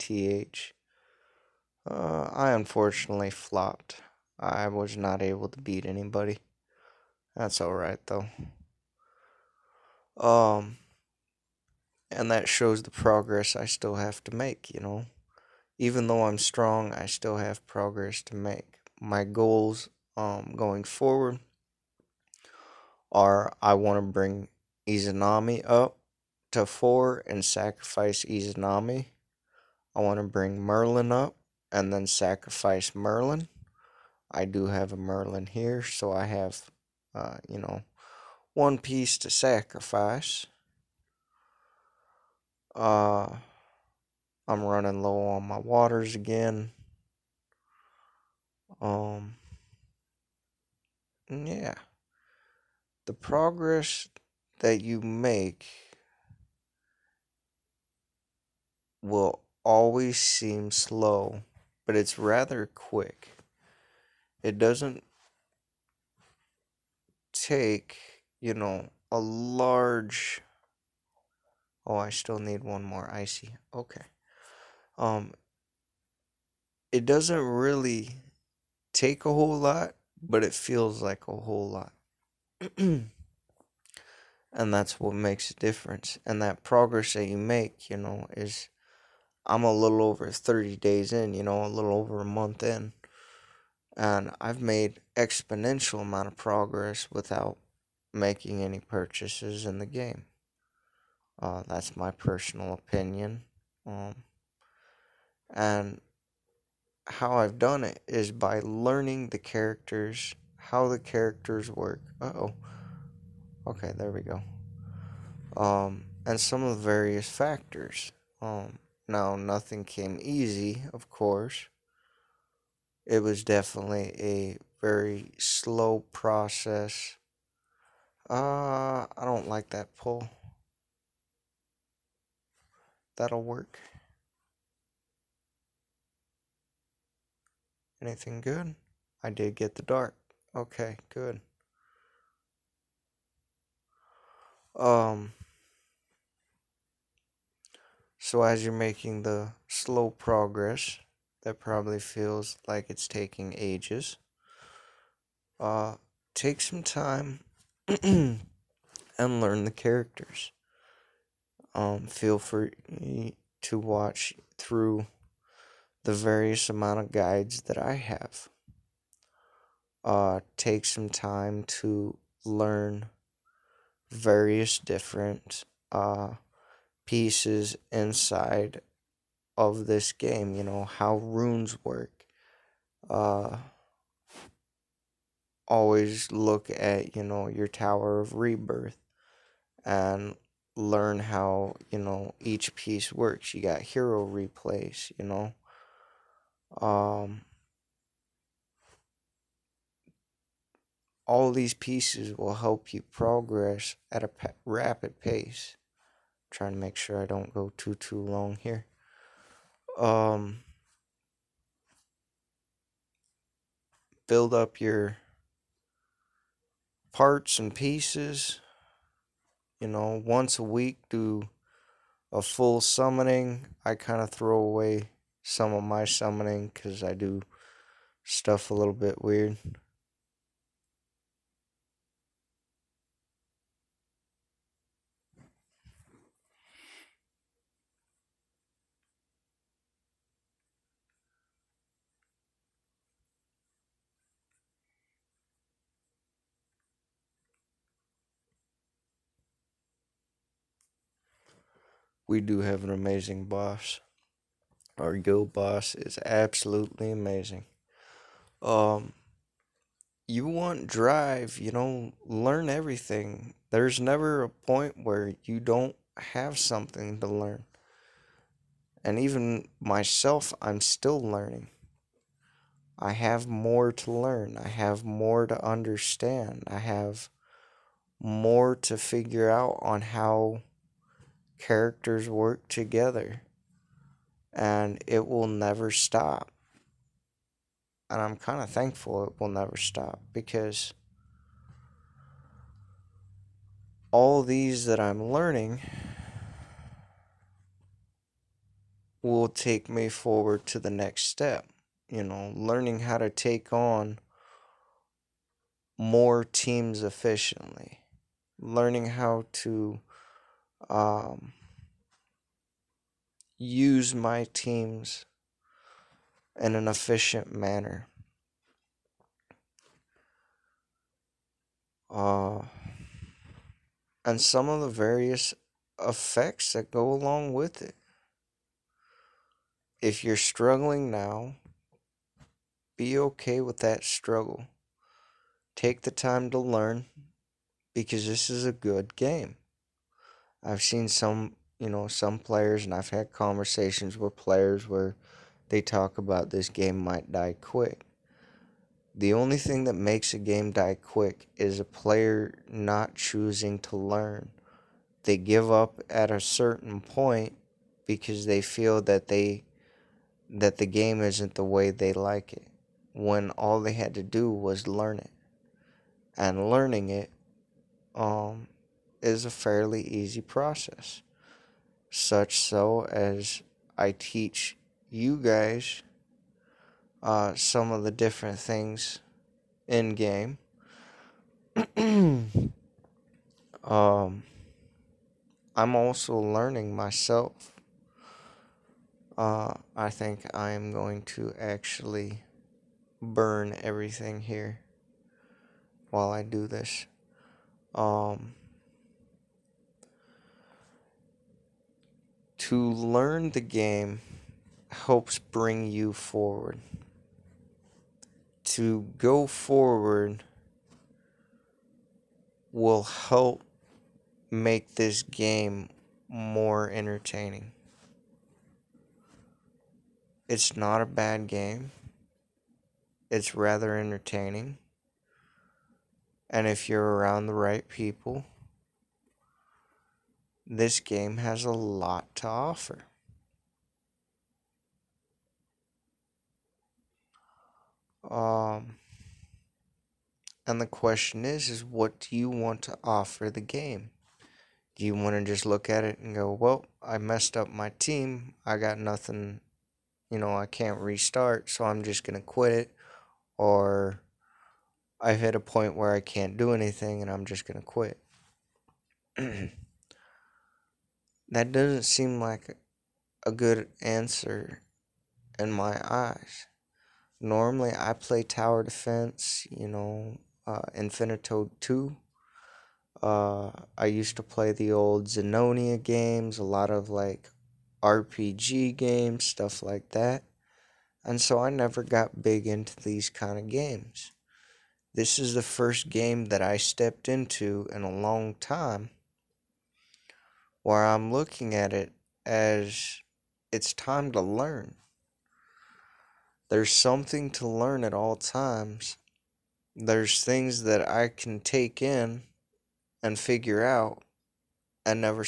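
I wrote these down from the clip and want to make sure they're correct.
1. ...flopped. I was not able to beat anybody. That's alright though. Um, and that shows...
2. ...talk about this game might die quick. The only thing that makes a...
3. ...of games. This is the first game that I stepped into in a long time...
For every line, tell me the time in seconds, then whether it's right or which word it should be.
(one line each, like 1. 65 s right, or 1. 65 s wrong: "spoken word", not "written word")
1. 3 s right
2. 345 s right
3. 483 s right.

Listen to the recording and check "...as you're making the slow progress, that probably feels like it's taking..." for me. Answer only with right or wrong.
right.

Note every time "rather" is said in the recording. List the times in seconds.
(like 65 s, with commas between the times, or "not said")
62 s, 423 s.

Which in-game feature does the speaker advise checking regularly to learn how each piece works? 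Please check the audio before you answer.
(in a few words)
Tower of Rebirth.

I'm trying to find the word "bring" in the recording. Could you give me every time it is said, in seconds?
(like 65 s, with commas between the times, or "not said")
24 s, 30 s, 405 s.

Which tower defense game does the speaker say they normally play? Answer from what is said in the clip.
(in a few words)
Infinitode 2.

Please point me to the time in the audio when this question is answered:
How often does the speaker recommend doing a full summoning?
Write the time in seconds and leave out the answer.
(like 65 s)
220 s.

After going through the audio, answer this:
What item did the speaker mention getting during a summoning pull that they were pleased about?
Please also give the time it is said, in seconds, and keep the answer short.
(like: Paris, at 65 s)
the dart, at 139 s.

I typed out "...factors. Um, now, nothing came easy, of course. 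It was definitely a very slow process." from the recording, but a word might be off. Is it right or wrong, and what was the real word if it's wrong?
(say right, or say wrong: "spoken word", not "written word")
right.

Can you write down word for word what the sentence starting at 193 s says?
You got hero replays, you know.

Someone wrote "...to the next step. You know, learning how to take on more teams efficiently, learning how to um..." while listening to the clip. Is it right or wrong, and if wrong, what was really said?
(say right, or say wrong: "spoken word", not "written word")
right.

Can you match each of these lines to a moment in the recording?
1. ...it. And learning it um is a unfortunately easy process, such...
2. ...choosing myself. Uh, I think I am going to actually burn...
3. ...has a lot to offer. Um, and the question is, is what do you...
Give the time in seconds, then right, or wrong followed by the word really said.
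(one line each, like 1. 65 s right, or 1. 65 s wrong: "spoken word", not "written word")
1. 365 s wrong: "fairly", not "unfortunately"
2. 386 s wrong: "learning", not "choosing"
3. 431 s right.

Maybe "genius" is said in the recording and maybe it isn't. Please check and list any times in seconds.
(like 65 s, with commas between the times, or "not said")
not said.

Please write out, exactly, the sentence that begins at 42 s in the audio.
Uh, I'm running low on my waters again.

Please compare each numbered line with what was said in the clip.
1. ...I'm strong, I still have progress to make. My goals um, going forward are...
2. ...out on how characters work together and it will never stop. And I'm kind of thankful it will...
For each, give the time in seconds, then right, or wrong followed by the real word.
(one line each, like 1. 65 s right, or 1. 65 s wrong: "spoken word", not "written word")
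1. 16 s right
2. 279 s right.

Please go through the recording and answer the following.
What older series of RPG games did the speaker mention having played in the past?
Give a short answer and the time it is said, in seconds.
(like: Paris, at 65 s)
Zenonia, at 475 s.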